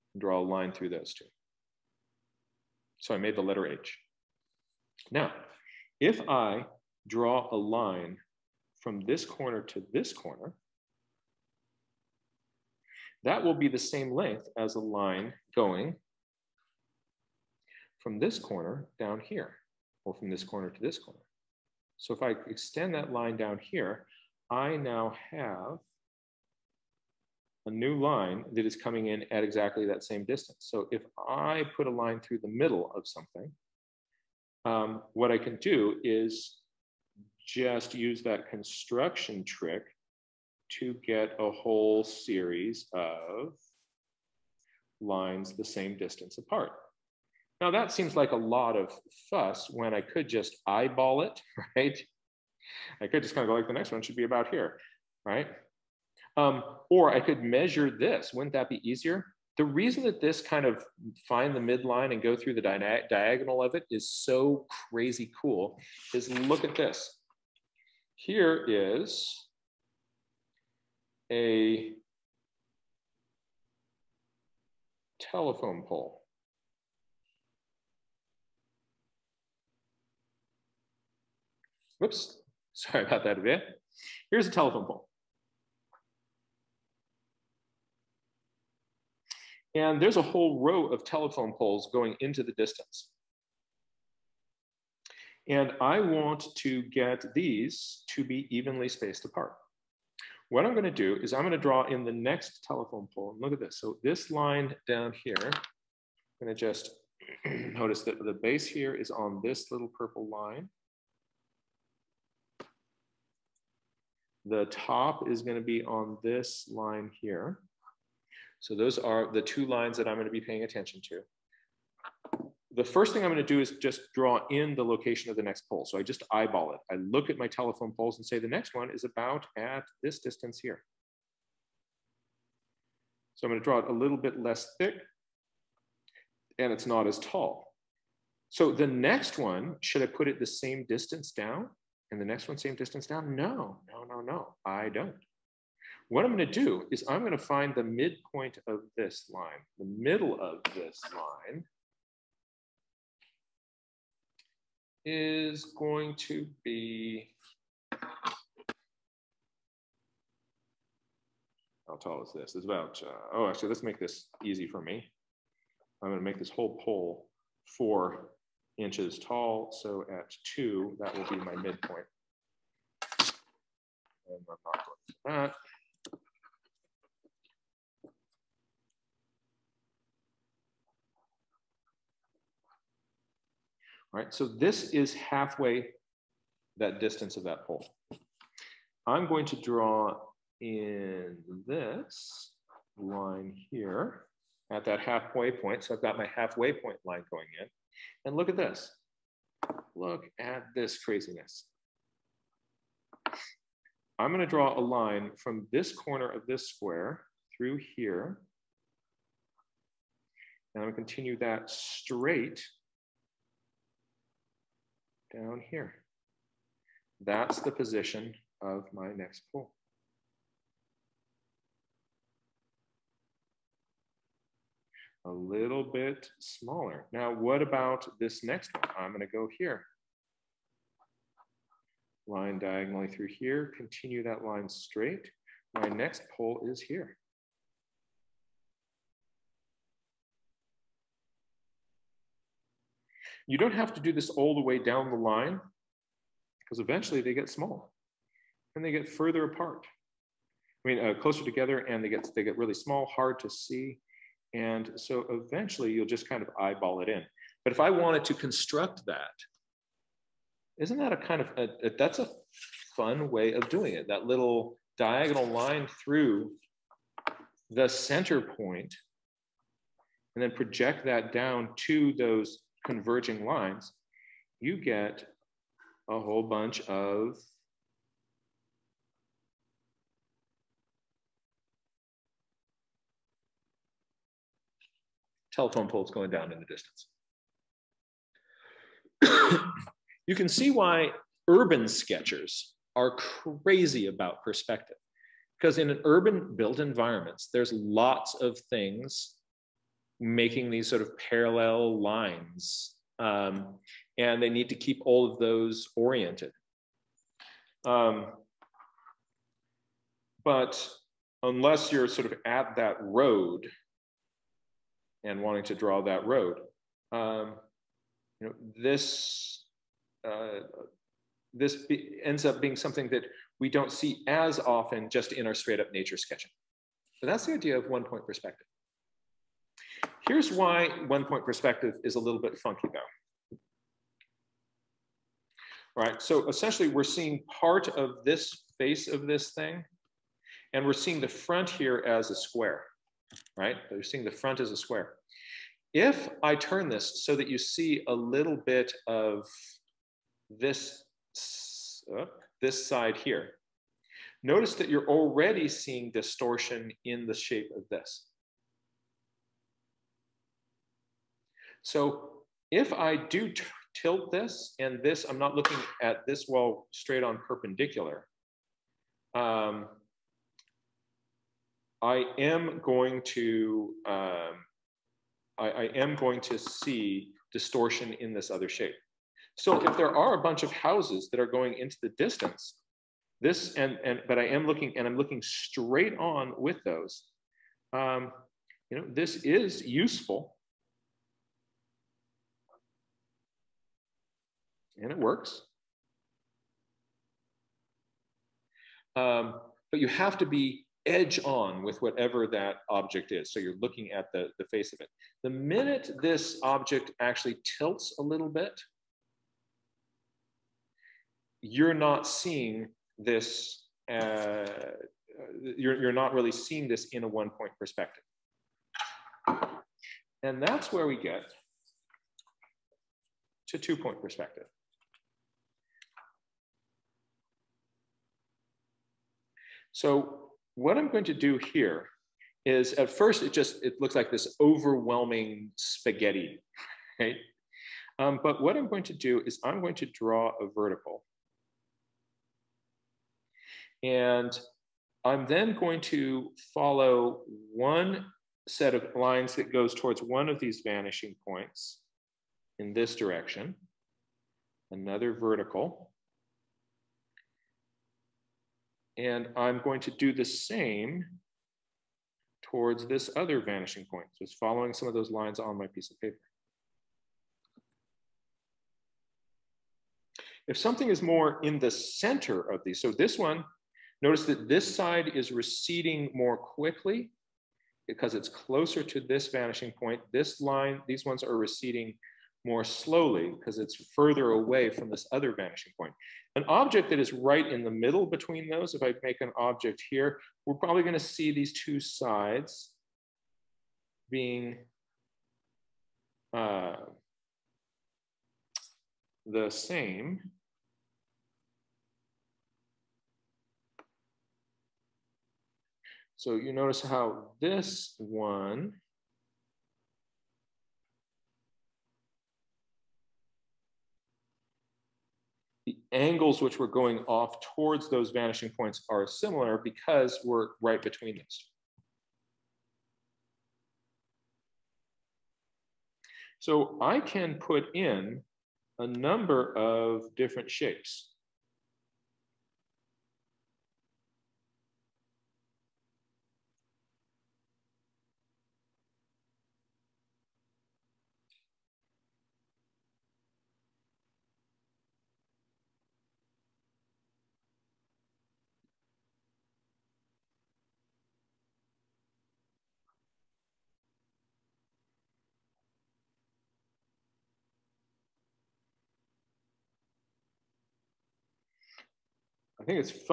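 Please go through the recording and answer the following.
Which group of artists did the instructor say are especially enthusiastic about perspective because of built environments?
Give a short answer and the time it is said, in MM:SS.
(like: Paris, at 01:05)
Urban sketchers, at 04:51.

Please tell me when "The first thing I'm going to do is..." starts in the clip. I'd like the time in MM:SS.
02:02.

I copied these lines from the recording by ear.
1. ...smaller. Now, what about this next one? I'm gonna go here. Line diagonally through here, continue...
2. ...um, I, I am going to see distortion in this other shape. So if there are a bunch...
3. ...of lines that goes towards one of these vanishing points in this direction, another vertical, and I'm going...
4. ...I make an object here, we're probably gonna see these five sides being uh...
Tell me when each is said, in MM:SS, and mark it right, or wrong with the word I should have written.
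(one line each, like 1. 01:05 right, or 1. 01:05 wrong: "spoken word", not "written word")
1. 03:46 right
2. 06:14 right
3. 07:28 right
4. 08:09 wrong: "two", not "five".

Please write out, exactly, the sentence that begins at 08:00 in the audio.
This line, these ones are receding more slowly because it's further away from this other vanishing point.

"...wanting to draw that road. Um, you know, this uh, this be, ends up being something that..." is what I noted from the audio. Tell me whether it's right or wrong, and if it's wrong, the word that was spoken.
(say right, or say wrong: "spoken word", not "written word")
right.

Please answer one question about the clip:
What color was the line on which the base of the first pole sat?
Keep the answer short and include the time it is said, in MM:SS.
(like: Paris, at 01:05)
Purple, at 01:49.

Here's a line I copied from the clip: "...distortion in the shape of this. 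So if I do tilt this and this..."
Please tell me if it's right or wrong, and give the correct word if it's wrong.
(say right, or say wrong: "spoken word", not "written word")
right.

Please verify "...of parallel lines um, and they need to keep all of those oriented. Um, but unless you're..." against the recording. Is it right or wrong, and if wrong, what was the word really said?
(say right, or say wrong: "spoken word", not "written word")
right.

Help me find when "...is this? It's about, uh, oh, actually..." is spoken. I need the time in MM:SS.
02:42.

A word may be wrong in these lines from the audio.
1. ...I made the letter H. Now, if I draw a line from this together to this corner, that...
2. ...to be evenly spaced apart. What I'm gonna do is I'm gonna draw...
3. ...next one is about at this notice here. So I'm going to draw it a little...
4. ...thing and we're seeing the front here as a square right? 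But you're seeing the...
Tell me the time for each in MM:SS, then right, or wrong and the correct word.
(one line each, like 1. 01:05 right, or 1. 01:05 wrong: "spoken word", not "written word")
1. 00:03 wrong: "corner", not "together"
2. 01:38 right
3. 02:08 wrong: "distance", not "notice"
4. 05:39 right.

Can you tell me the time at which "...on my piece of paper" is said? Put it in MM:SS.
07:45.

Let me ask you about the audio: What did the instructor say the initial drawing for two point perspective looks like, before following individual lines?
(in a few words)
Overwhelming spaghetti.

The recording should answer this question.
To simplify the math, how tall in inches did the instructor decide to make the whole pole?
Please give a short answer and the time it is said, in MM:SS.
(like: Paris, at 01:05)
4 inches, at 02:47.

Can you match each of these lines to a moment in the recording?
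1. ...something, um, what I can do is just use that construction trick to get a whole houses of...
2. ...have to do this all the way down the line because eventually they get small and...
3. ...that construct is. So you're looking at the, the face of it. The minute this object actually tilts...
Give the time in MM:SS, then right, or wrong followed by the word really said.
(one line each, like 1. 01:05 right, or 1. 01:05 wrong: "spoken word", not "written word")
1. 00:33 wrong: "series", not "houses"
2. 04:03 right
3. 06:42 wrong: "object", not "construct".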